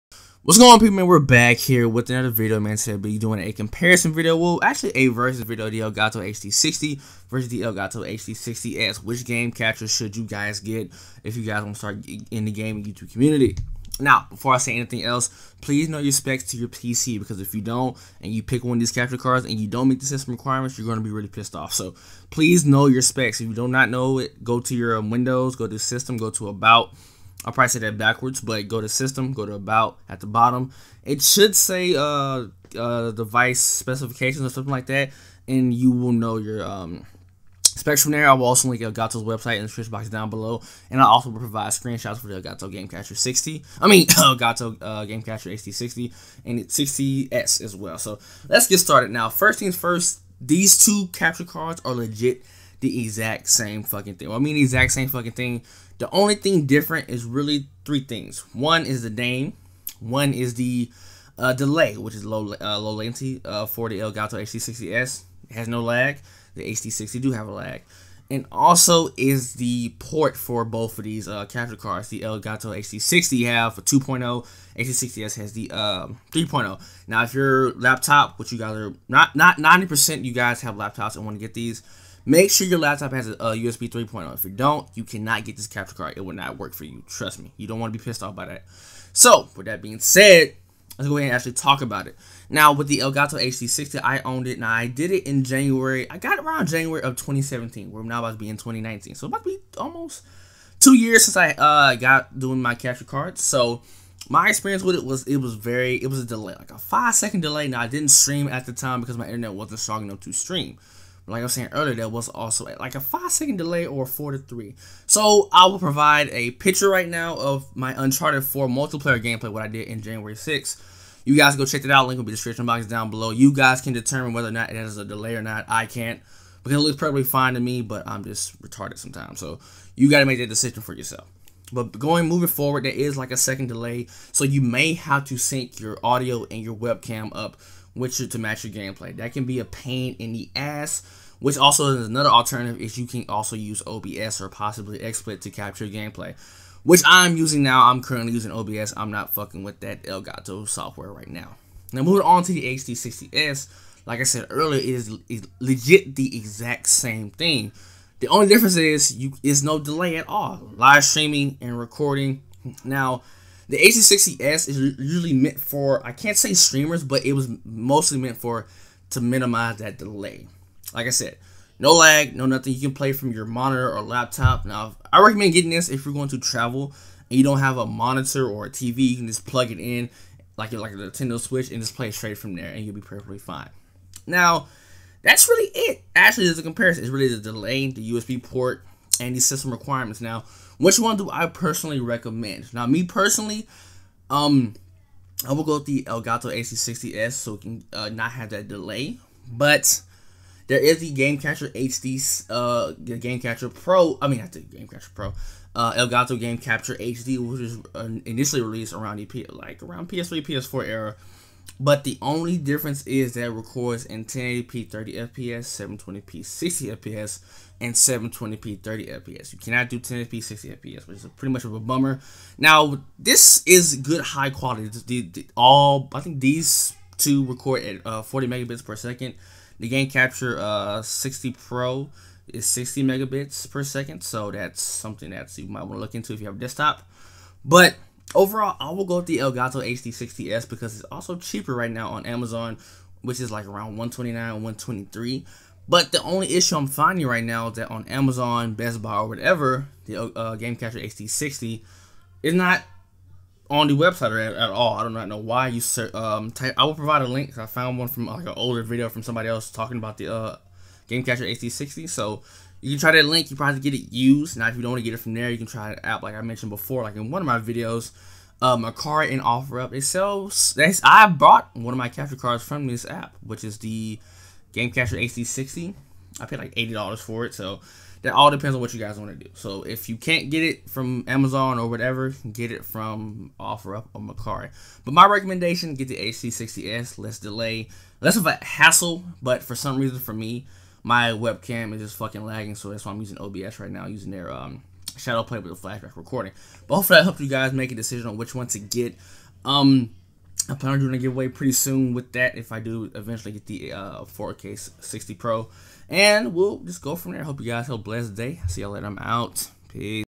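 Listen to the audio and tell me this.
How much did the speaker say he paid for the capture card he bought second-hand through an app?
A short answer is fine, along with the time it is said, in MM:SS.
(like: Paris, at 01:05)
$80, at 04:36.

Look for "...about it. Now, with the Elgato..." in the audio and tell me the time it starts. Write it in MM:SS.
01:31.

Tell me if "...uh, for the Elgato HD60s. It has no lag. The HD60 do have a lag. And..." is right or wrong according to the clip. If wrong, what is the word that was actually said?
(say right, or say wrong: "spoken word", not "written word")
right.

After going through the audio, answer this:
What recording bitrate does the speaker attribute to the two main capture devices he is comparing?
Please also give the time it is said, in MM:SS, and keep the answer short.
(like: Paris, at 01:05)
40 megabits per second, at 03:48.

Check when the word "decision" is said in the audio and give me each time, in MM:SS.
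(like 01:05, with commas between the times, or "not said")
02:10, 04:57.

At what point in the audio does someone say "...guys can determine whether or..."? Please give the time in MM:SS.
02:03.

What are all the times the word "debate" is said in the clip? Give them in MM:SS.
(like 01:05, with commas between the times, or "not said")
not said.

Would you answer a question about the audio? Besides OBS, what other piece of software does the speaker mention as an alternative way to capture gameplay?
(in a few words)
XSplit.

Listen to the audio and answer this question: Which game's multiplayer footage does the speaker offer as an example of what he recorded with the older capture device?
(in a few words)
Uncharted 4.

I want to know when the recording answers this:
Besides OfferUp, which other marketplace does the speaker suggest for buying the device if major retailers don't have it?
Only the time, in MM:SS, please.
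04:44.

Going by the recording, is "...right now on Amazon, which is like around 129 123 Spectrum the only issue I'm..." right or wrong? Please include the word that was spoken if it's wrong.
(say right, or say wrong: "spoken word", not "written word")
wrong: "But", not "Spectrum".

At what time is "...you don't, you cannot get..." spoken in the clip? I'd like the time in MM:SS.
01:24.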